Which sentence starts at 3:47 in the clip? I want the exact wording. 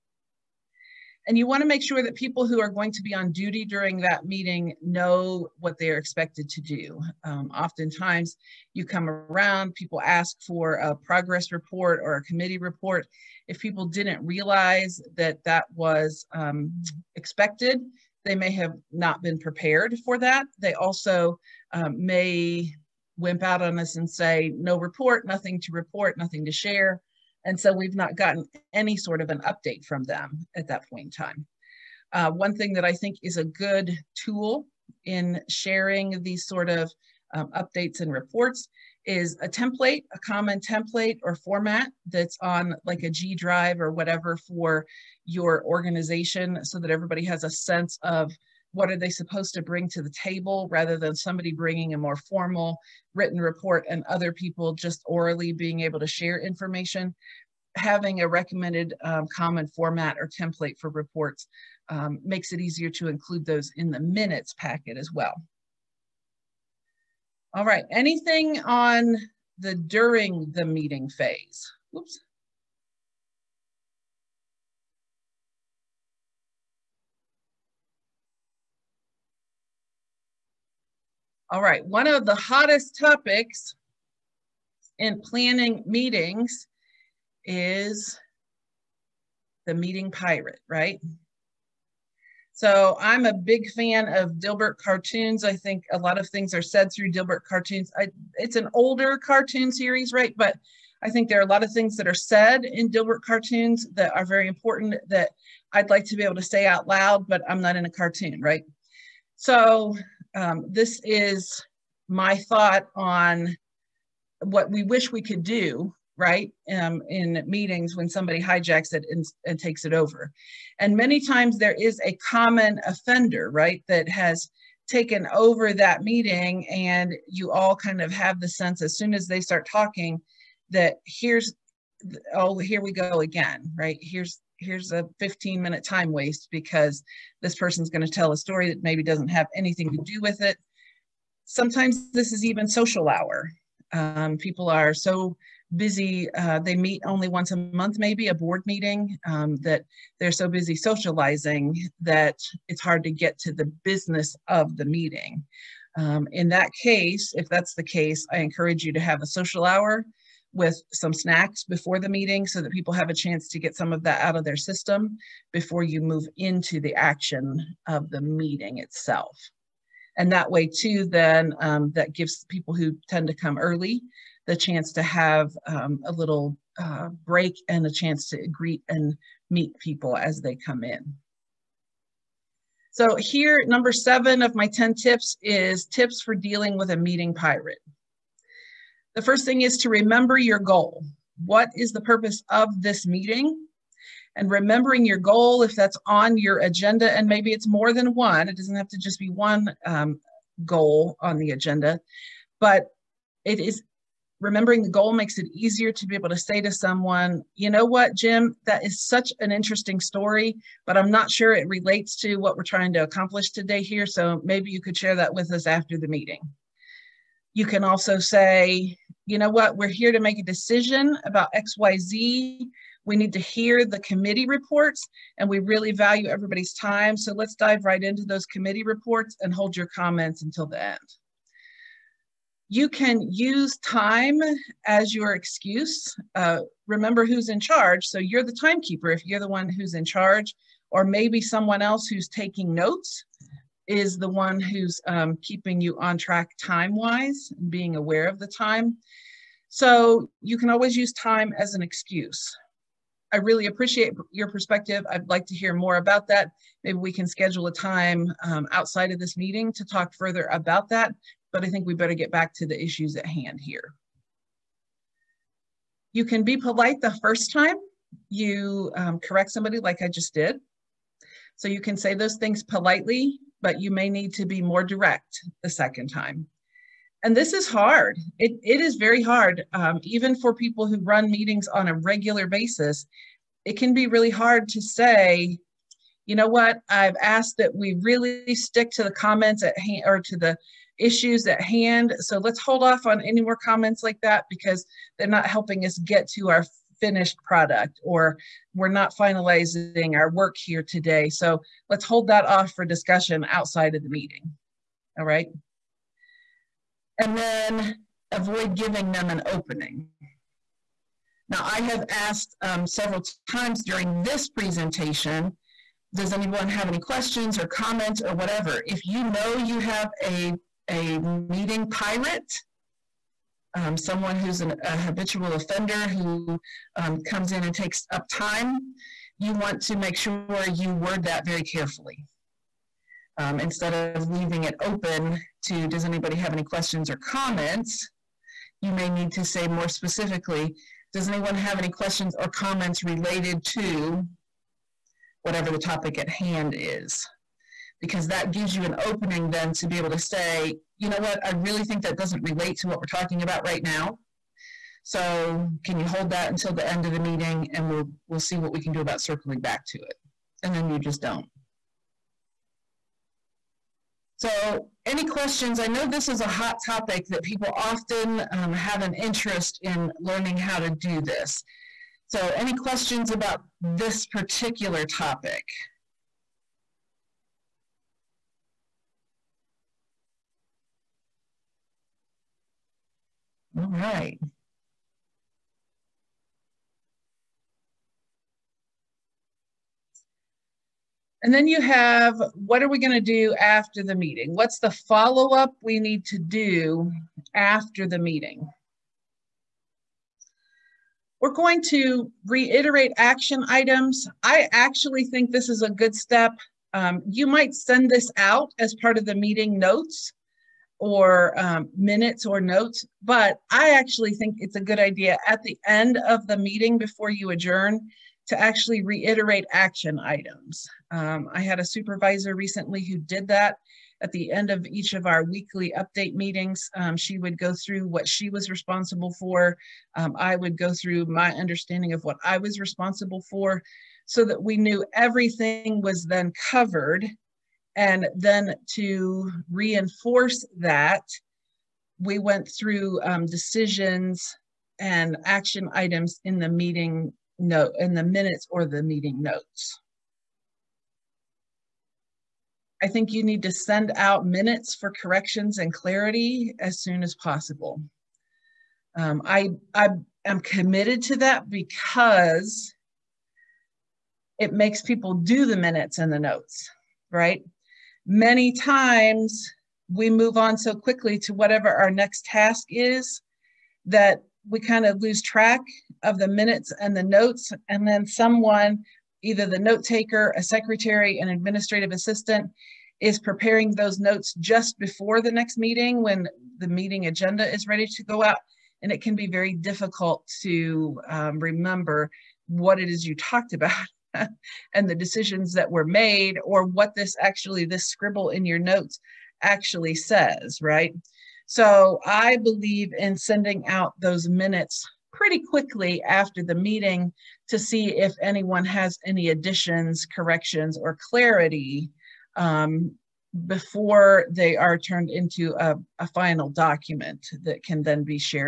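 So let's dive right into those committee reports and hold your comments until the end.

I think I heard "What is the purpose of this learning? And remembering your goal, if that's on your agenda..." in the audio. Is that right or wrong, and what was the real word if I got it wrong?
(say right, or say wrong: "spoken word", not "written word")
wrong: "meeting", not "learning".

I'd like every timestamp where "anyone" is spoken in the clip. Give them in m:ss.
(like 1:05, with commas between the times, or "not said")
5:16, 5:41, 8:28.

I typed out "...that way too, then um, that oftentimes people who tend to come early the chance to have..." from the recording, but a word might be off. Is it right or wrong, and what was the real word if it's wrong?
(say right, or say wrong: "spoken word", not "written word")
wrong: "gives", not "oftentimes".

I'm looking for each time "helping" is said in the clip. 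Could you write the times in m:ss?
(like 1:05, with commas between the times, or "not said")
4:55.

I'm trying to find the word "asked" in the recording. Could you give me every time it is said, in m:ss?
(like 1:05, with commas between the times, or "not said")
4:47, 5:12.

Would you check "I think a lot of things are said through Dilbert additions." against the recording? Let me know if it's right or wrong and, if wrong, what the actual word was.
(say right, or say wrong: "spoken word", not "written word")
wrong: "cartoons", not "additions".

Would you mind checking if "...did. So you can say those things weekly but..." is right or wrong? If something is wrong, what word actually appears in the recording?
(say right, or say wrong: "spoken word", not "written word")
wrong: "politely", not "weekly".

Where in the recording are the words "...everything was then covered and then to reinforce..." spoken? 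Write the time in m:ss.
7:15.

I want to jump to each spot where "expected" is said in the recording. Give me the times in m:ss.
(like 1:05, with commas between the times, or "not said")
0:05, 0:17.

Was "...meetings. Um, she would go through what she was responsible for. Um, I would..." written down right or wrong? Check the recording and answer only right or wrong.
right.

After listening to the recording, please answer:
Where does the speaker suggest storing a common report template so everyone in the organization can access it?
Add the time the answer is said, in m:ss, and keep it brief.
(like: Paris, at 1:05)
G drive, at 0:43.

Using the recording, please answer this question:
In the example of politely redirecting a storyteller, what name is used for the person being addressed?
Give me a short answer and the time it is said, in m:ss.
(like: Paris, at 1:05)
Jim, at 3:28.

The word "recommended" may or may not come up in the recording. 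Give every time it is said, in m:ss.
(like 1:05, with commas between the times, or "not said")
0:58.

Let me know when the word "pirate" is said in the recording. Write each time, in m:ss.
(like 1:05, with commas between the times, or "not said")
1:30, 3:07, 5:21.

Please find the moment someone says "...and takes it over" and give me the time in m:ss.
1:59.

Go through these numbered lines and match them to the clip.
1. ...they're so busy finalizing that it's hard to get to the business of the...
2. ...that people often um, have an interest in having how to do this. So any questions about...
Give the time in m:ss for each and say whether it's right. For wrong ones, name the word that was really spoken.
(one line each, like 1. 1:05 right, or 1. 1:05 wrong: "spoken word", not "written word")
1. 2:30 wrong: "socializing", not "finalizing"
2. 6:07 wrong: "learning", not "having".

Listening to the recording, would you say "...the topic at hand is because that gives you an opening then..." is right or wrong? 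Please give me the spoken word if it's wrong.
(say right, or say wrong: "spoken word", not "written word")
right.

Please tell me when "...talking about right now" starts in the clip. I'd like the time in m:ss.
5:53.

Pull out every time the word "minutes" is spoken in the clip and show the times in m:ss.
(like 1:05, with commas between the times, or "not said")
1:03, 2:15, 6:51, 7:28, 7:34, 7:45, 7:56, 8:24.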